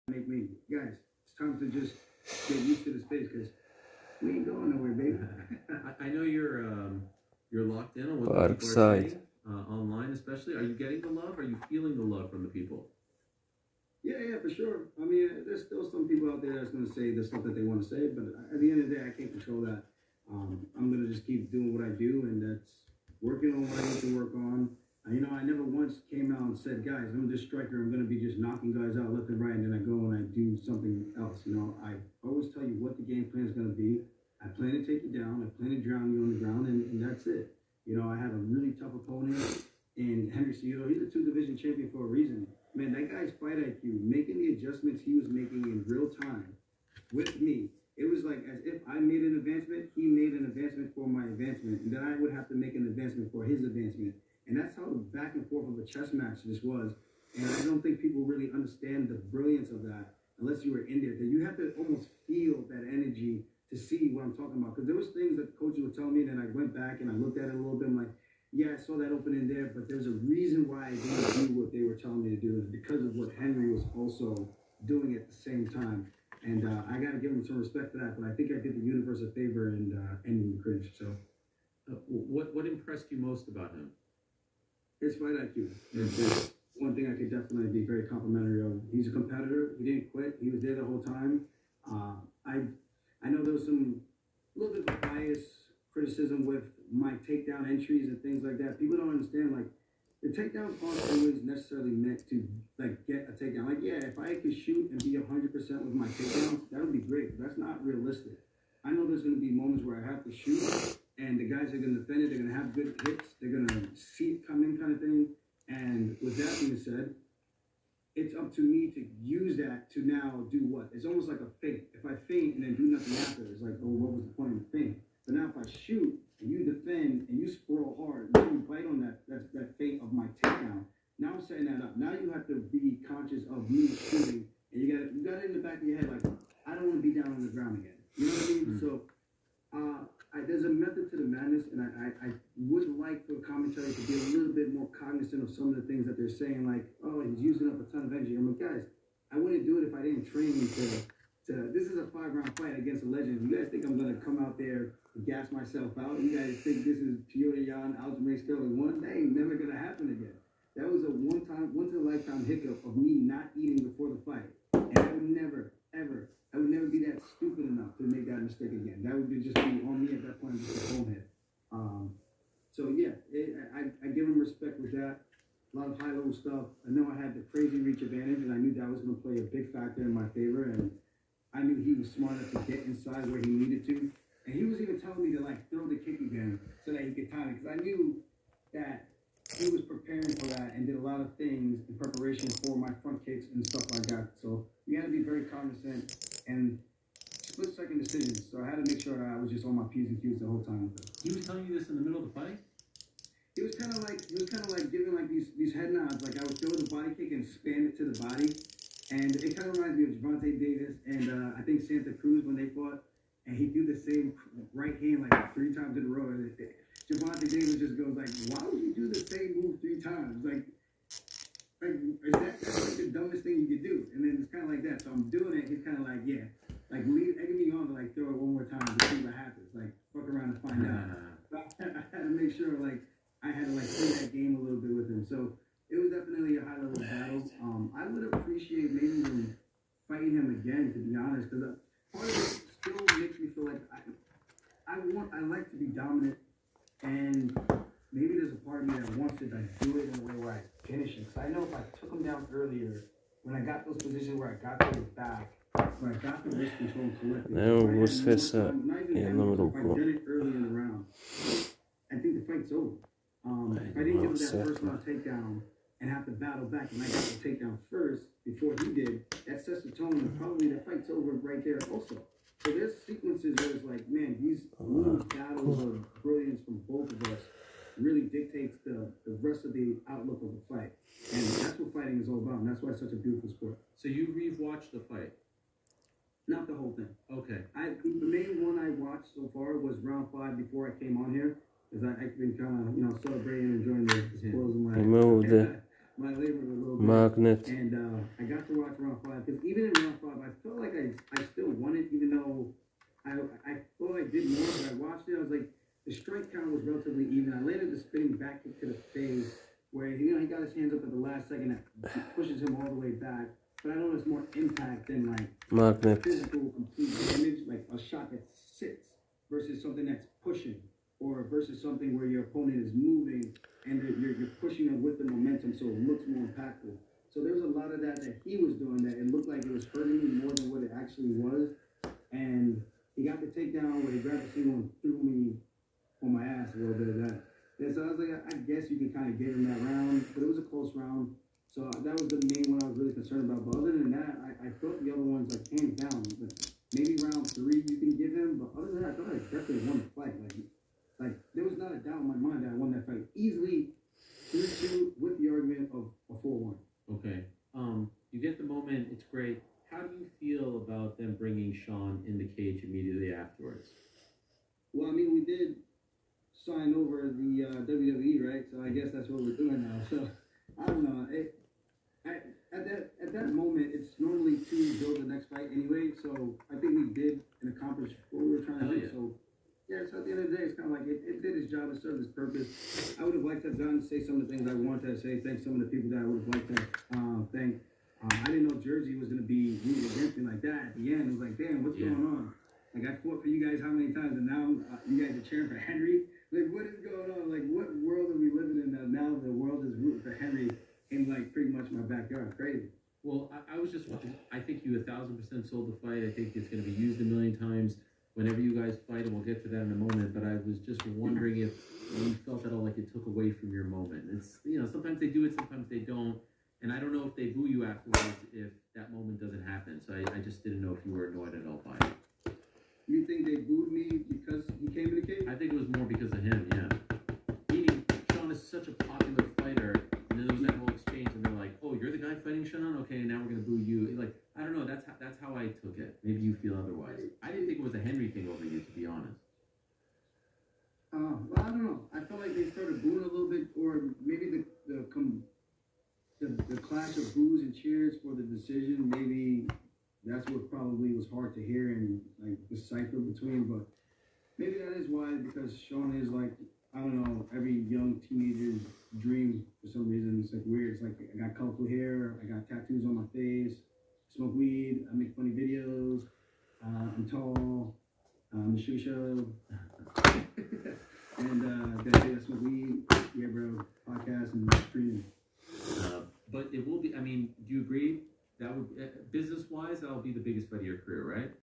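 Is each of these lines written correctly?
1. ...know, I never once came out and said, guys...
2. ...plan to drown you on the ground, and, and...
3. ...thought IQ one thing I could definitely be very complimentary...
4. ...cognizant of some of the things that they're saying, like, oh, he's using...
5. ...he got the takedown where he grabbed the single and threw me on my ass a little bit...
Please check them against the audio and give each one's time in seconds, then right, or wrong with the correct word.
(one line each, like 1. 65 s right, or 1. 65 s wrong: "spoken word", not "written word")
1. 25 s right
2. 35 s right
3. 85 s wrong: "fight", not "thought"
4. 144 s right
5. 333 s right.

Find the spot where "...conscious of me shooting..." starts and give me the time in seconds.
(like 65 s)
133 s.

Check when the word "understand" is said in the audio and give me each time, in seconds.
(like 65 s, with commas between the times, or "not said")
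58 s, 99 s.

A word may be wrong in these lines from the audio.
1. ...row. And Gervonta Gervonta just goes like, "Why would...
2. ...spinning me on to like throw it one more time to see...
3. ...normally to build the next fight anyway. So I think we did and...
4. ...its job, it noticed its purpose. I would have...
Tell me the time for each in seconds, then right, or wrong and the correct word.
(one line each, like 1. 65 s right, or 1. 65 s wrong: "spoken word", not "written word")
1. 216 s wrong: "Davis", not "Gervonta"
2. 227 s wrong: "egging", not "spinning"
3. 374 s right
4. 381 s wrong: "served", not "noticed".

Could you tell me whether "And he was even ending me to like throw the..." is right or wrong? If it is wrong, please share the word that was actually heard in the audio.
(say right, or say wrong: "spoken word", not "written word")
wrong: "telling", not "ending".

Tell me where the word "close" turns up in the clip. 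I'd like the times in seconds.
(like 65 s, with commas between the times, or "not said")
340 s.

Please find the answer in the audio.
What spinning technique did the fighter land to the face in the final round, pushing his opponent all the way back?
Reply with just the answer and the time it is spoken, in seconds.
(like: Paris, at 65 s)
Spinning back kick, at 307 s.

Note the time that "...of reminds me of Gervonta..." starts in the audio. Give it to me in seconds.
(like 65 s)
209 s.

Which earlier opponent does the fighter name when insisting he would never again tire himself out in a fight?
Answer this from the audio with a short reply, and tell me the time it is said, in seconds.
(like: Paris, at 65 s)
Petr Yan, at 157 s.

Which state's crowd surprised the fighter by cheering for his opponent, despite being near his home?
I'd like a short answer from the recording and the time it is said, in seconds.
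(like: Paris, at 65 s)
Jersey, at 388 s.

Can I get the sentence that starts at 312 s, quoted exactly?
That pushes him all the way back.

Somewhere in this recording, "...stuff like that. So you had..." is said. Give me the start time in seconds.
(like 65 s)
193 s.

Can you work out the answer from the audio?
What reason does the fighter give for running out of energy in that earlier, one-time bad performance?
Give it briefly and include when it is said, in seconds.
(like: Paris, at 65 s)
Not eating before the fight, at 163 s.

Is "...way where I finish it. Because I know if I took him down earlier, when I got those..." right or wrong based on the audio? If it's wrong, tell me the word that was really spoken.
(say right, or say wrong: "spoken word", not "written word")
right.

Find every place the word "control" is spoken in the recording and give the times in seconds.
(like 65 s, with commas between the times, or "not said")
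19 s, 256 s.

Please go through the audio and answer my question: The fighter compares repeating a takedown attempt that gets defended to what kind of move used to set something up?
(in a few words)
A fake.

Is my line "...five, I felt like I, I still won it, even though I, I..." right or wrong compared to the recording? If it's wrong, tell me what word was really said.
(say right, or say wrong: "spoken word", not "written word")
right.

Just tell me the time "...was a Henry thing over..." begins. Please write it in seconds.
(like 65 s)
437 s.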